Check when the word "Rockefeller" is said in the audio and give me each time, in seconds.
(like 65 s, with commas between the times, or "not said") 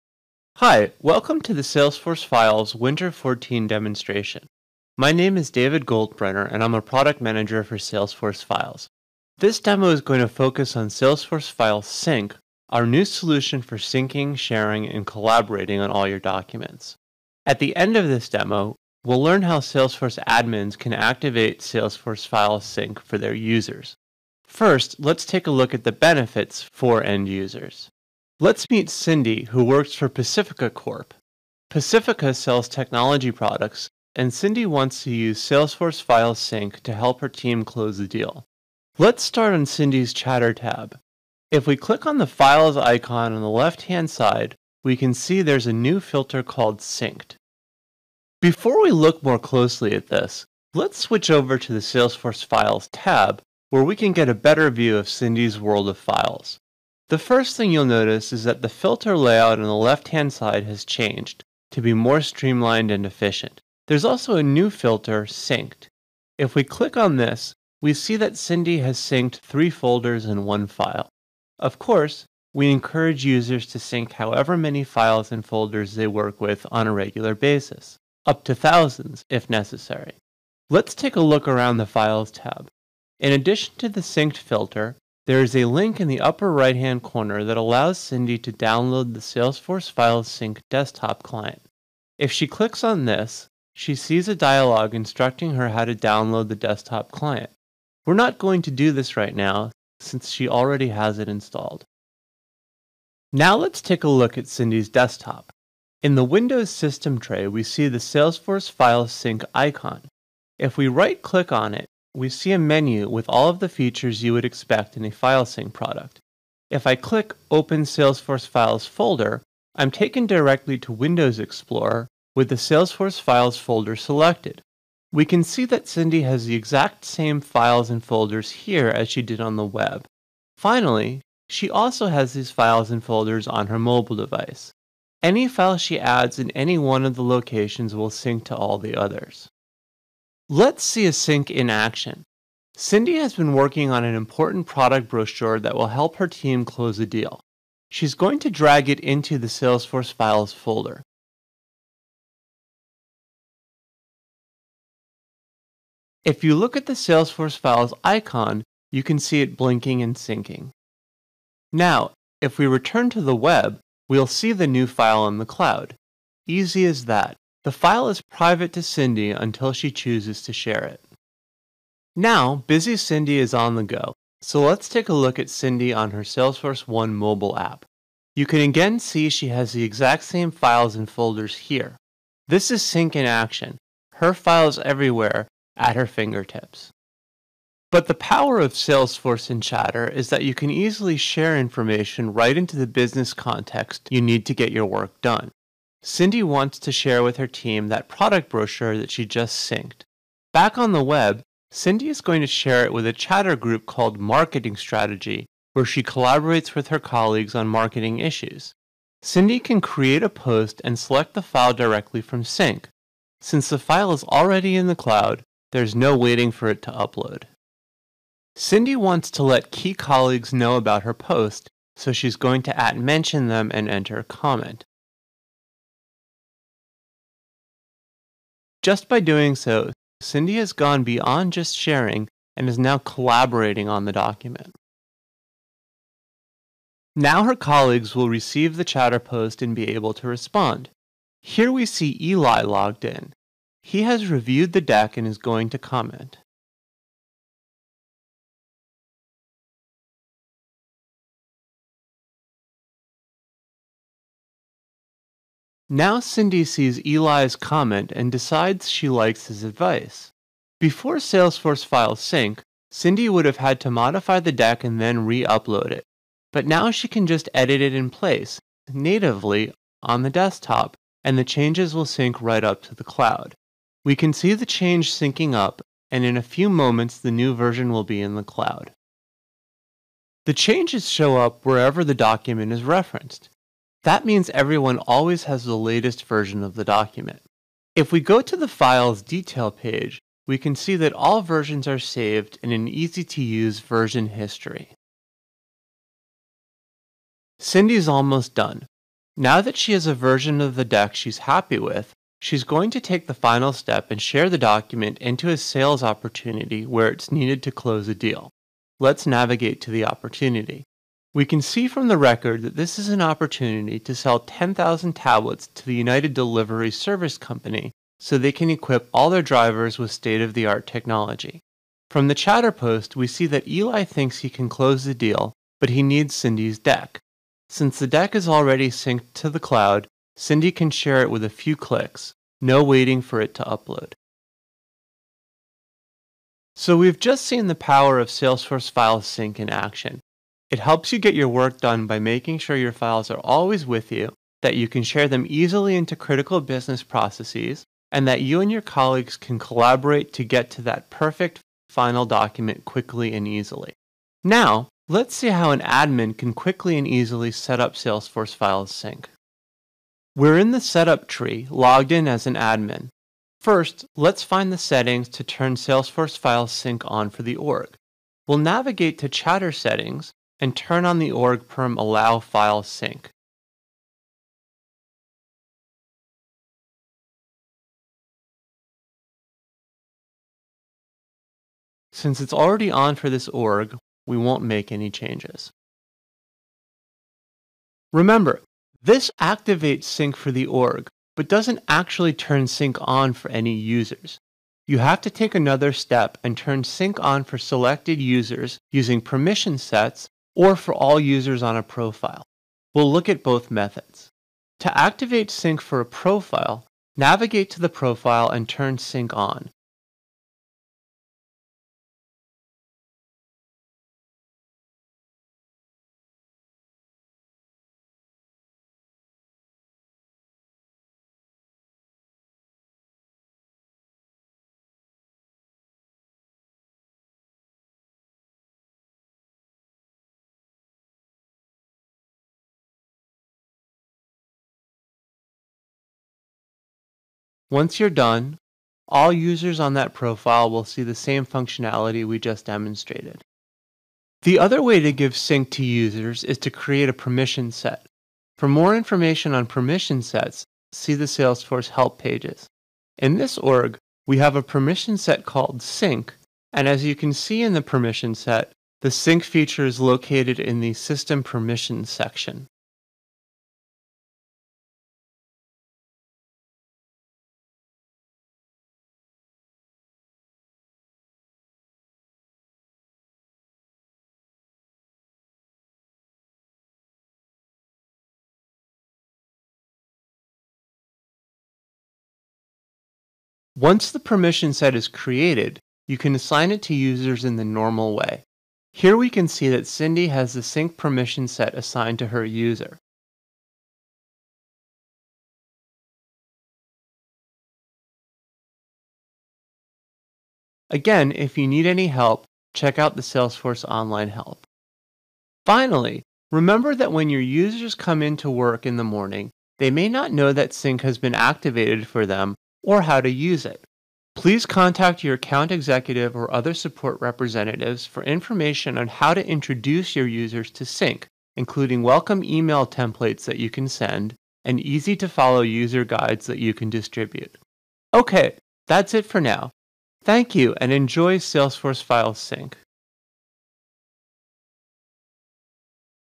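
not said.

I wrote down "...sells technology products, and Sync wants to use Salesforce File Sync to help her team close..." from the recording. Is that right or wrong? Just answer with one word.
wrong.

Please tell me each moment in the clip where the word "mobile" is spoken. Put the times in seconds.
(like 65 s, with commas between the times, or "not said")
133 s, 177 s.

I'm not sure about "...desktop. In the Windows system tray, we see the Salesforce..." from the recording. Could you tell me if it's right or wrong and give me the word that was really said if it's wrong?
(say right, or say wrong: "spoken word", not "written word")
right.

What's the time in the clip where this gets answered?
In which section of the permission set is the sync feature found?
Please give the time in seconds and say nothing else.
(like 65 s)
460 s.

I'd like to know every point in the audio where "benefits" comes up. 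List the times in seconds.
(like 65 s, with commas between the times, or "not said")
25 s.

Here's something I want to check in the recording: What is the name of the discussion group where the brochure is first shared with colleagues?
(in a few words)
Marketing Strategy.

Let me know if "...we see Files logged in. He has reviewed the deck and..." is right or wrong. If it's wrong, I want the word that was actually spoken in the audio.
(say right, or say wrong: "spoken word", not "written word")
wrong: "Eli", not "Files".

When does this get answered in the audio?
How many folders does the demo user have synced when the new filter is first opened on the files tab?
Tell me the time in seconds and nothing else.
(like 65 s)
69 s.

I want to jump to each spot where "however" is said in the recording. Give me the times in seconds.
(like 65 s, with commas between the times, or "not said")
74 s.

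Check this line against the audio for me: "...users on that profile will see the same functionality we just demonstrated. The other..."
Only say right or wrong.
right.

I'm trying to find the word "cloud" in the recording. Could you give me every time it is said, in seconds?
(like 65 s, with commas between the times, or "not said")
165 s, 214 s, 273 s, 278 s, 329 s.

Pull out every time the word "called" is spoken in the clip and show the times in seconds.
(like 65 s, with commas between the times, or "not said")
46 s, 203 s, 455 s.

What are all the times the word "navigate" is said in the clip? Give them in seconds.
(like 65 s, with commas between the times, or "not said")
309 s, 368 s, 407 s.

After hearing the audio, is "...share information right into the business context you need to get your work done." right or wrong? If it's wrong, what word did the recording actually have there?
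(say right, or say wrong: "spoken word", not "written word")
right.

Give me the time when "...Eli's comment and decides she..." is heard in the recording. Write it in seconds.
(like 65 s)
257 s.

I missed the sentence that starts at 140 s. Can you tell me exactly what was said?
Let's see a sync in action.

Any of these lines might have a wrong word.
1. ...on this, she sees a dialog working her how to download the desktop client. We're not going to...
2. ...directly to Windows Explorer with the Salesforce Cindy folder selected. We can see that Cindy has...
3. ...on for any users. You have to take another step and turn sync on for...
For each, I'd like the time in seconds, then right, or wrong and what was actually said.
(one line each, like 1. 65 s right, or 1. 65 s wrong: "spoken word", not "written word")
1. 92 s wrong: "instructing", not "working"
2. 120 s wrong: "Files", not "Cindy"
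3. 393 s right.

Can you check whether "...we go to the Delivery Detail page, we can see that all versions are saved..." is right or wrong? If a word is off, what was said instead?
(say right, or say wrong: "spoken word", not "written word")
wrong: "Files", not "Delivery".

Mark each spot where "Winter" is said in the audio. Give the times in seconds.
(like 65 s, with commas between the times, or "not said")
2 s.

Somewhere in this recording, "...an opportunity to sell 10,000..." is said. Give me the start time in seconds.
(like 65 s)
313 s.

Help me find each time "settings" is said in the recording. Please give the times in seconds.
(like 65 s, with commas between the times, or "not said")
364 s, 369 s.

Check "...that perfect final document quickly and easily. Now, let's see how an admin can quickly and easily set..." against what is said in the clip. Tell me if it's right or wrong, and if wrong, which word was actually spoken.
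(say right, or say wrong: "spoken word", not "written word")
right.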